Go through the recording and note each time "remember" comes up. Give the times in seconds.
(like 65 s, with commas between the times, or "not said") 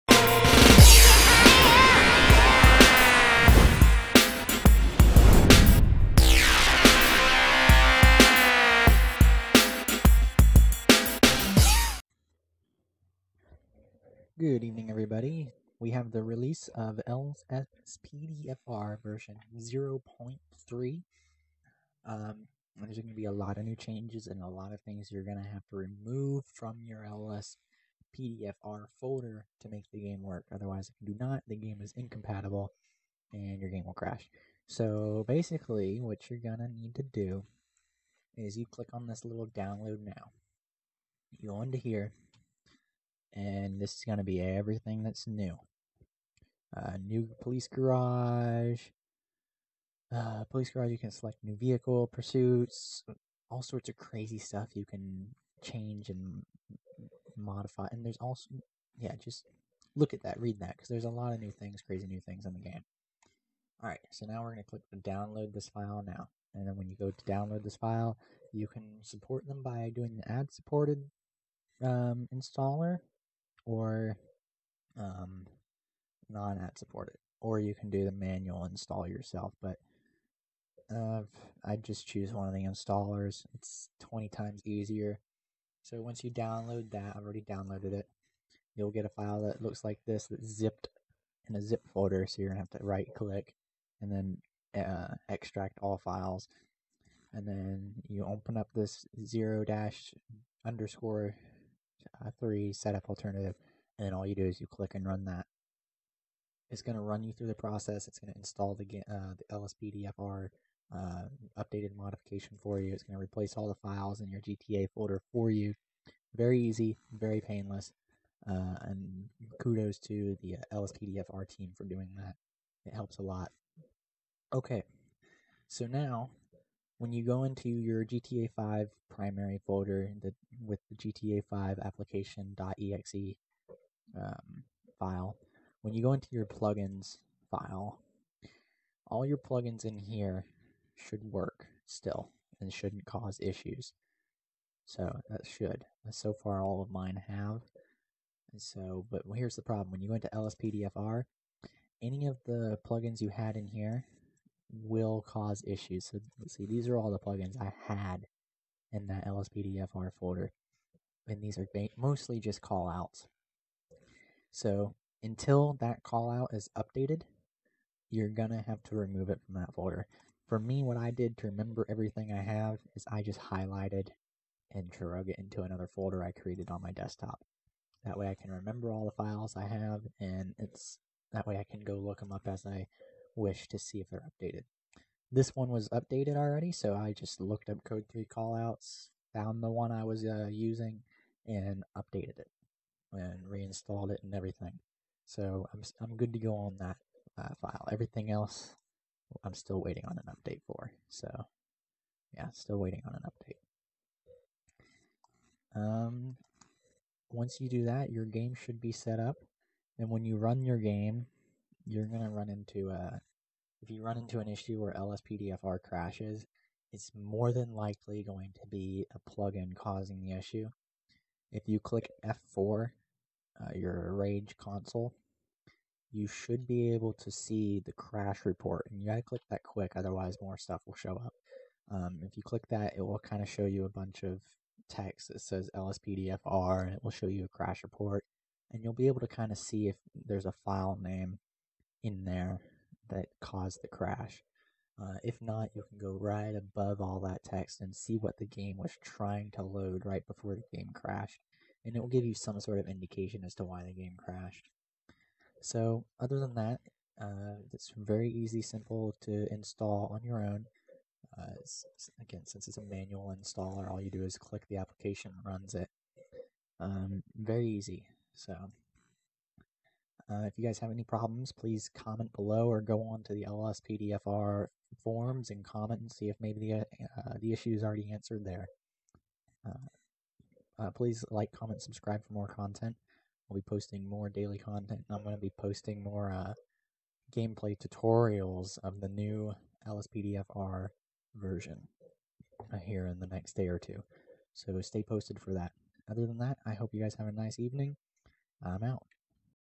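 171 s, 178 s.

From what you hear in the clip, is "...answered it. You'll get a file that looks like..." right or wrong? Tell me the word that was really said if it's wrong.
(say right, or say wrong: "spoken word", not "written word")
wrong: "downloaded", not "answered".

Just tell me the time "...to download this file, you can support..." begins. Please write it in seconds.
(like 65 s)
67 s.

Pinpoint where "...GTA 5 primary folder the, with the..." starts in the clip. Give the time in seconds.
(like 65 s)
128 s.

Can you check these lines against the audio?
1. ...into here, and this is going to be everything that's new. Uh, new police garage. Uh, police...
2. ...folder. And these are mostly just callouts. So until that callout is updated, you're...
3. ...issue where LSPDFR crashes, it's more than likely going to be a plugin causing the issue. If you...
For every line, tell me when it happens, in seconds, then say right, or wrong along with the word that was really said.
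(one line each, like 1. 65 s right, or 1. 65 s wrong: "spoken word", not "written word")
1. 41 s right
2. 160 s right
3. 214 s right.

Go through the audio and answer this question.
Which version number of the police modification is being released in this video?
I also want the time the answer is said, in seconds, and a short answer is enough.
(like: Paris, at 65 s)
0.3, at 19 s.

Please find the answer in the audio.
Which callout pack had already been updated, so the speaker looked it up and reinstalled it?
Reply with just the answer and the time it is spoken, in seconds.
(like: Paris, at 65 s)
Code 3 callouts, at 187 s.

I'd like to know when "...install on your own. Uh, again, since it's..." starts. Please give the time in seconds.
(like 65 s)
259 s.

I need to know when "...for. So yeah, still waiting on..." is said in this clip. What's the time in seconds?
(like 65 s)
200 s.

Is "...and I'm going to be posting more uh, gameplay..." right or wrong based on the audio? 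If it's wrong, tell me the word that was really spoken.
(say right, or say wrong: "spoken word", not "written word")
right.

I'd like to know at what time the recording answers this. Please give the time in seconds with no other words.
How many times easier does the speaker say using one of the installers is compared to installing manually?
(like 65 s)
83 s.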